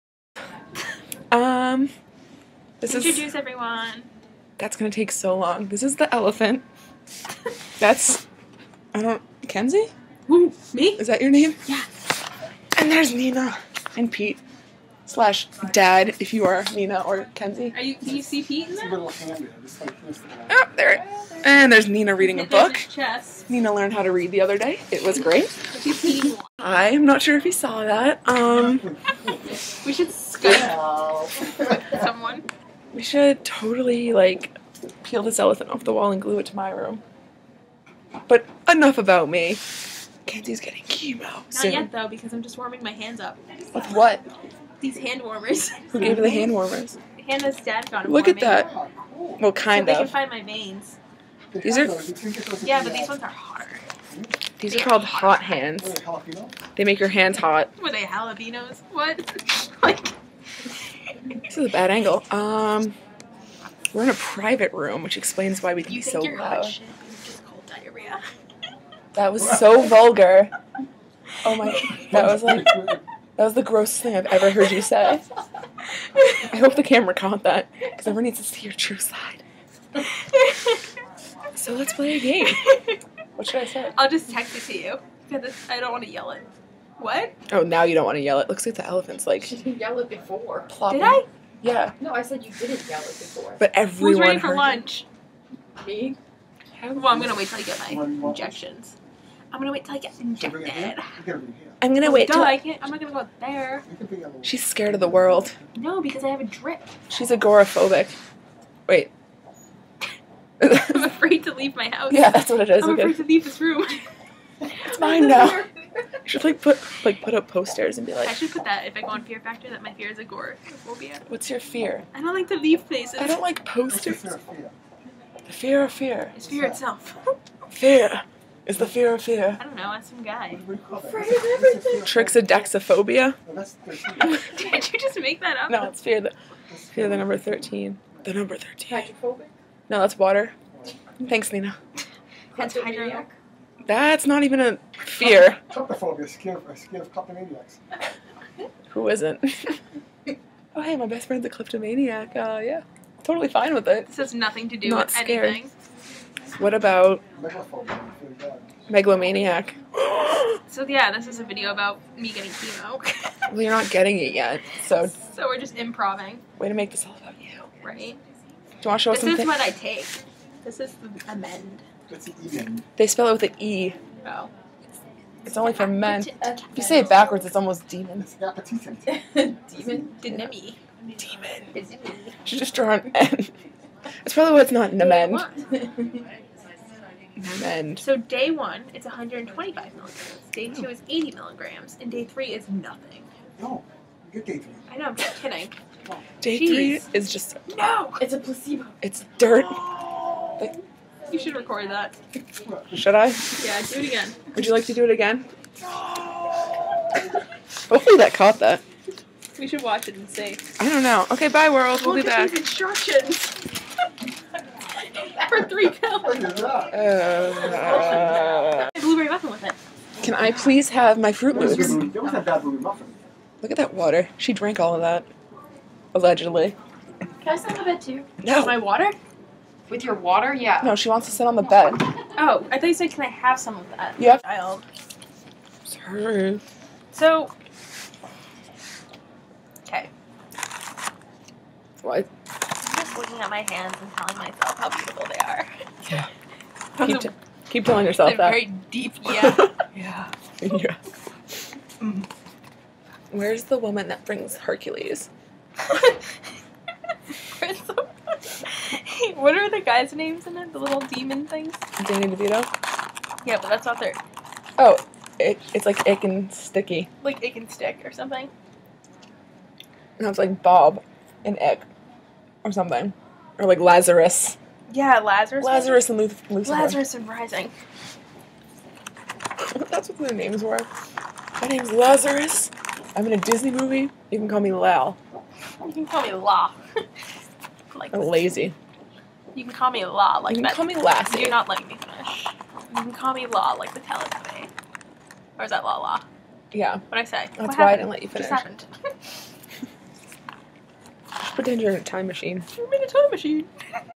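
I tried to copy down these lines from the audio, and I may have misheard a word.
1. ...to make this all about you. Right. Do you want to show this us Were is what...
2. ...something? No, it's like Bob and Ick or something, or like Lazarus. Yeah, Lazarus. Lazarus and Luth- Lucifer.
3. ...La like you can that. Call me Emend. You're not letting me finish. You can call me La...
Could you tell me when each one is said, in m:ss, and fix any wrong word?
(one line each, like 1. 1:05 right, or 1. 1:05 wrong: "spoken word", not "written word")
1. 2:46 wrong: "This", not "Were"
2. 4:28 right
3. 4:50 wrong: "Lassie", not "Emend".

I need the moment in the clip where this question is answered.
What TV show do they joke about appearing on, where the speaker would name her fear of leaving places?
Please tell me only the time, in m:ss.
1:59.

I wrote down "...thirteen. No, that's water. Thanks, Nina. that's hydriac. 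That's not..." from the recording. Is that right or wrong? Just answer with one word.
right.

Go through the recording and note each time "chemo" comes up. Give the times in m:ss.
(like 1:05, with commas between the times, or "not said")
0:40, 2:42.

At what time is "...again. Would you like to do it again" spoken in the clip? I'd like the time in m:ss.
3:24.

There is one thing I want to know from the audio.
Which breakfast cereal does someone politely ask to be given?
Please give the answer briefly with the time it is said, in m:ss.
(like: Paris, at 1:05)
Fruit Loops, at 3:41.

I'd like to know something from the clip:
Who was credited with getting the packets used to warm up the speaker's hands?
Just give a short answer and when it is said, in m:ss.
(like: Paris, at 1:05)
Hannah's dad, at 0:47.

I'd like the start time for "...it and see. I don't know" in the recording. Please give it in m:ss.
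3:30.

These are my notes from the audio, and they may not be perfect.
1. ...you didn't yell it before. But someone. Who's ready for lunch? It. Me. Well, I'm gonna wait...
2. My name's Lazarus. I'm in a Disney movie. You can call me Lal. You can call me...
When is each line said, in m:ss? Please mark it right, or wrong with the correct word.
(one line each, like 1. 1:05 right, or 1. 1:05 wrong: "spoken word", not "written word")
1. 1:32 wrong: "everyone", not "someone"
2. 4:41 right.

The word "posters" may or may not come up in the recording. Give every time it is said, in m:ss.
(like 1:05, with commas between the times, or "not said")
1:57, 2:03.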